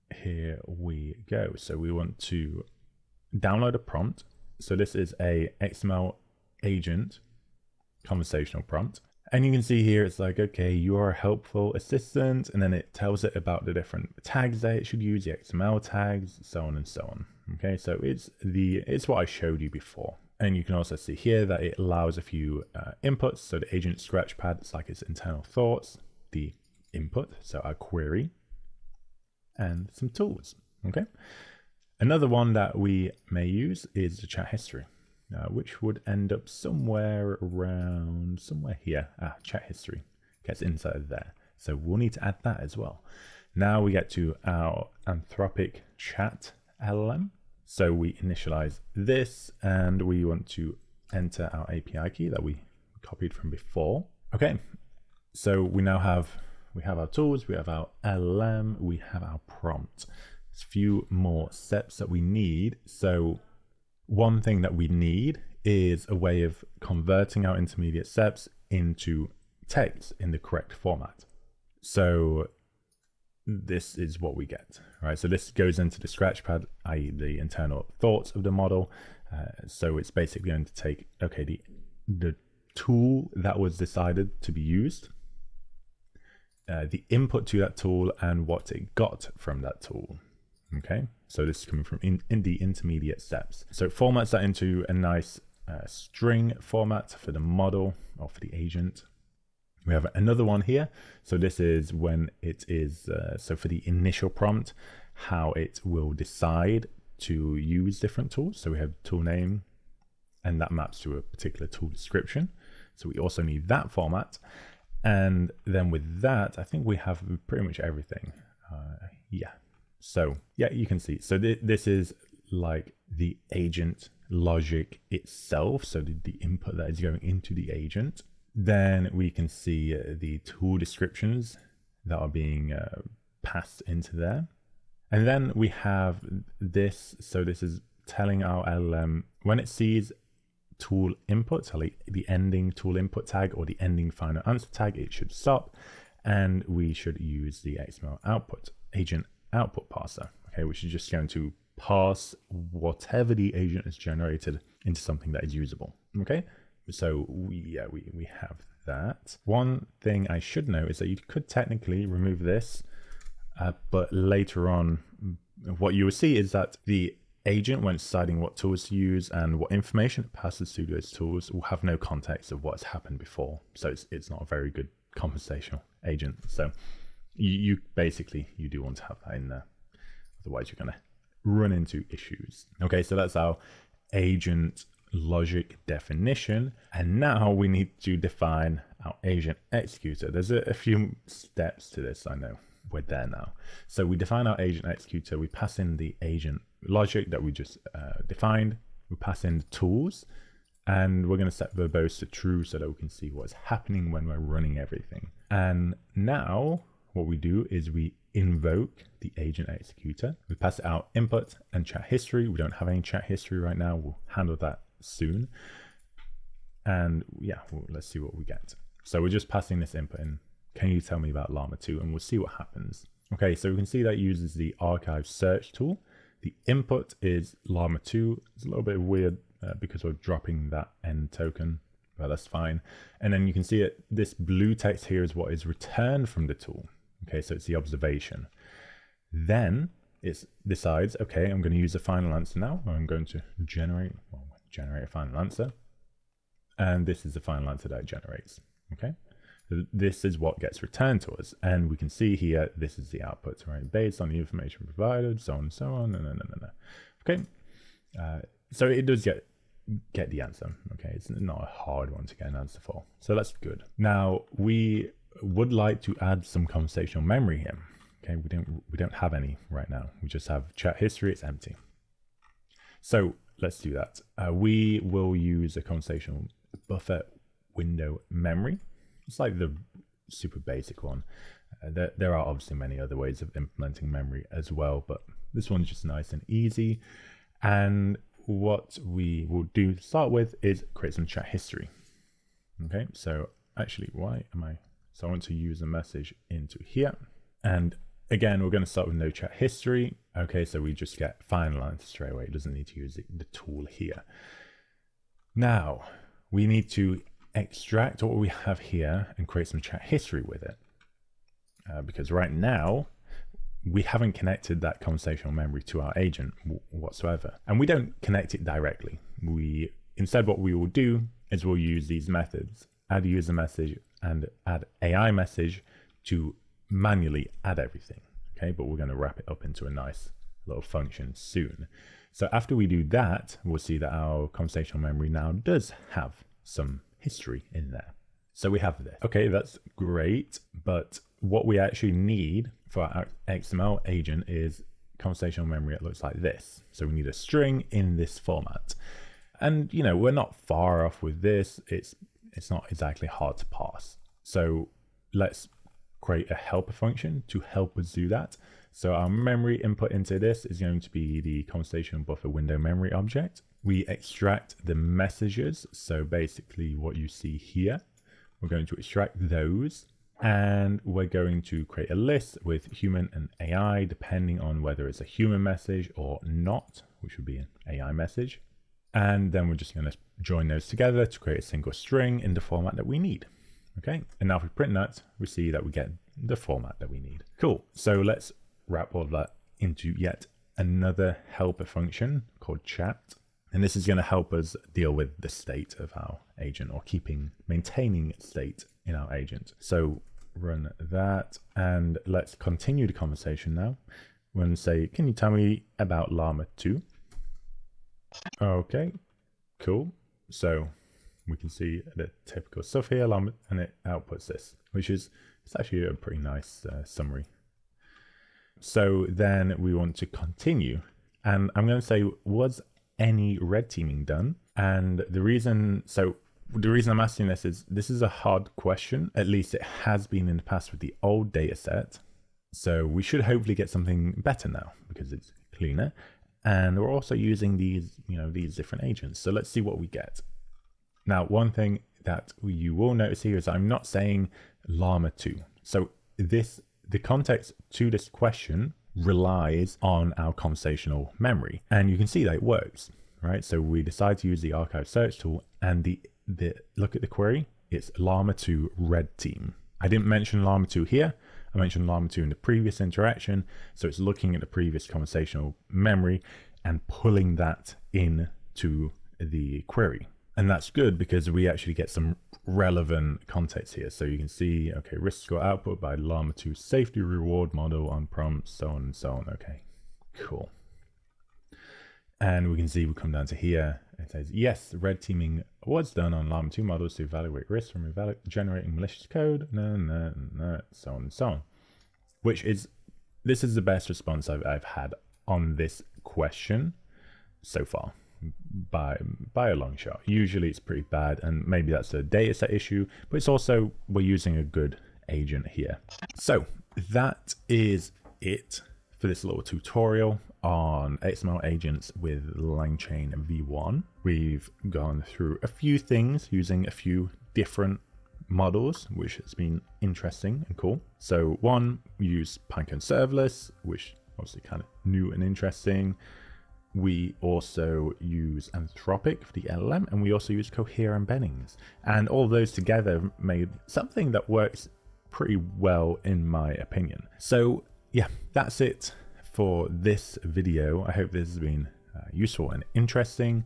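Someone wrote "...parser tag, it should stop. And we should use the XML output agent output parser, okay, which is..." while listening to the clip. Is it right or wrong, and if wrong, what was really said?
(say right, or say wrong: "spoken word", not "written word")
wrong: "answer", not "parser".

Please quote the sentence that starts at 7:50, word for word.
And that's good because we actually get some relevant context here.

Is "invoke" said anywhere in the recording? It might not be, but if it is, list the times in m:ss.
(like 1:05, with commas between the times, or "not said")
3:28.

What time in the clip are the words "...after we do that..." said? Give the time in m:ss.
5:32.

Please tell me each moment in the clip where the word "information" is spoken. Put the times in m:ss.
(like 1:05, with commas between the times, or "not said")
2:49, 4:14.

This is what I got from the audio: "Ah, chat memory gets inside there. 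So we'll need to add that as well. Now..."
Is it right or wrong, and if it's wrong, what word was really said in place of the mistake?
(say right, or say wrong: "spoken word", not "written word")
wrong: "history", not "memory".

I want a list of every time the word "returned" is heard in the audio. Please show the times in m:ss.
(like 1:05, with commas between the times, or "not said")
3:55, 4:10.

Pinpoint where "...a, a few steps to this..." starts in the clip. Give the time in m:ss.
3:10.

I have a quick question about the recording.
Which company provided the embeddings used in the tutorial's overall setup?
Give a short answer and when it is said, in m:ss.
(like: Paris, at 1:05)
Cohere, at 8:50.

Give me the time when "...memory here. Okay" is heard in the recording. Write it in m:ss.
4:27.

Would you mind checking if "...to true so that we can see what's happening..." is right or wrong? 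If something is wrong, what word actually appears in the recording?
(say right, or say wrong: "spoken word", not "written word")
right.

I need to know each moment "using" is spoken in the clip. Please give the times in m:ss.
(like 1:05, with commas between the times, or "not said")
7:17, 8:24, 8:36.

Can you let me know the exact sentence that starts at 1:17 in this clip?
the internal thoughts of the model.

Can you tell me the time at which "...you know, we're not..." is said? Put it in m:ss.
5:49.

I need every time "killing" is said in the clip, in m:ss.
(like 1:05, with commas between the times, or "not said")
not said.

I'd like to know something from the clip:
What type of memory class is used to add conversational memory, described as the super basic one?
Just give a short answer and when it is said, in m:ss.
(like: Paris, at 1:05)
conversational buffer window memory, at 4:35.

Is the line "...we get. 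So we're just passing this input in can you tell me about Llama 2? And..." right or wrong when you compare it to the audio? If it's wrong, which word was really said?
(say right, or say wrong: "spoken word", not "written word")
right.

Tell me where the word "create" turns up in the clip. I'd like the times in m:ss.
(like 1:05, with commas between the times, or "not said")
4:50, 5:09, 5:56, 6:11, 6:21.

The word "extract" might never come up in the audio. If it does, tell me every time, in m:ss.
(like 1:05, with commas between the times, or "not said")
5:07, 6:04, 6:08.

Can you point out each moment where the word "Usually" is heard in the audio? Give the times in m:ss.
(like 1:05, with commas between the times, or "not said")
8:20.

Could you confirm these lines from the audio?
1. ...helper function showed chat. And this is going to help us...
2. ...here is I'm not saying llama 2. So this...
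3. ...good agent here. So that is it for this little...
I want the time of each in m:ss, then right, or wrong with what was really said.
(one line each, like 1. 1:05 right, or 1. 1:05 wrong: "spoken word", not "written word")
1. 6:31 wrong: "called", not "showed"
2. 7:23 right
3. 8:24 right.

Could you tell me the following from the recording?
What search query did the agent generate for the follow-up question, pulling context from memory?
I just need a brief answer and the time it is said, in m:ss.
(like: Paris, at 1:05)
Llama 2 red team, at 7:38.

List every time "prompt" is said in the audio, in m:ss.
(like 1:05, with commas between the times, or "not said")
0:03, 0:08, 0:59, 1:44, 7:58.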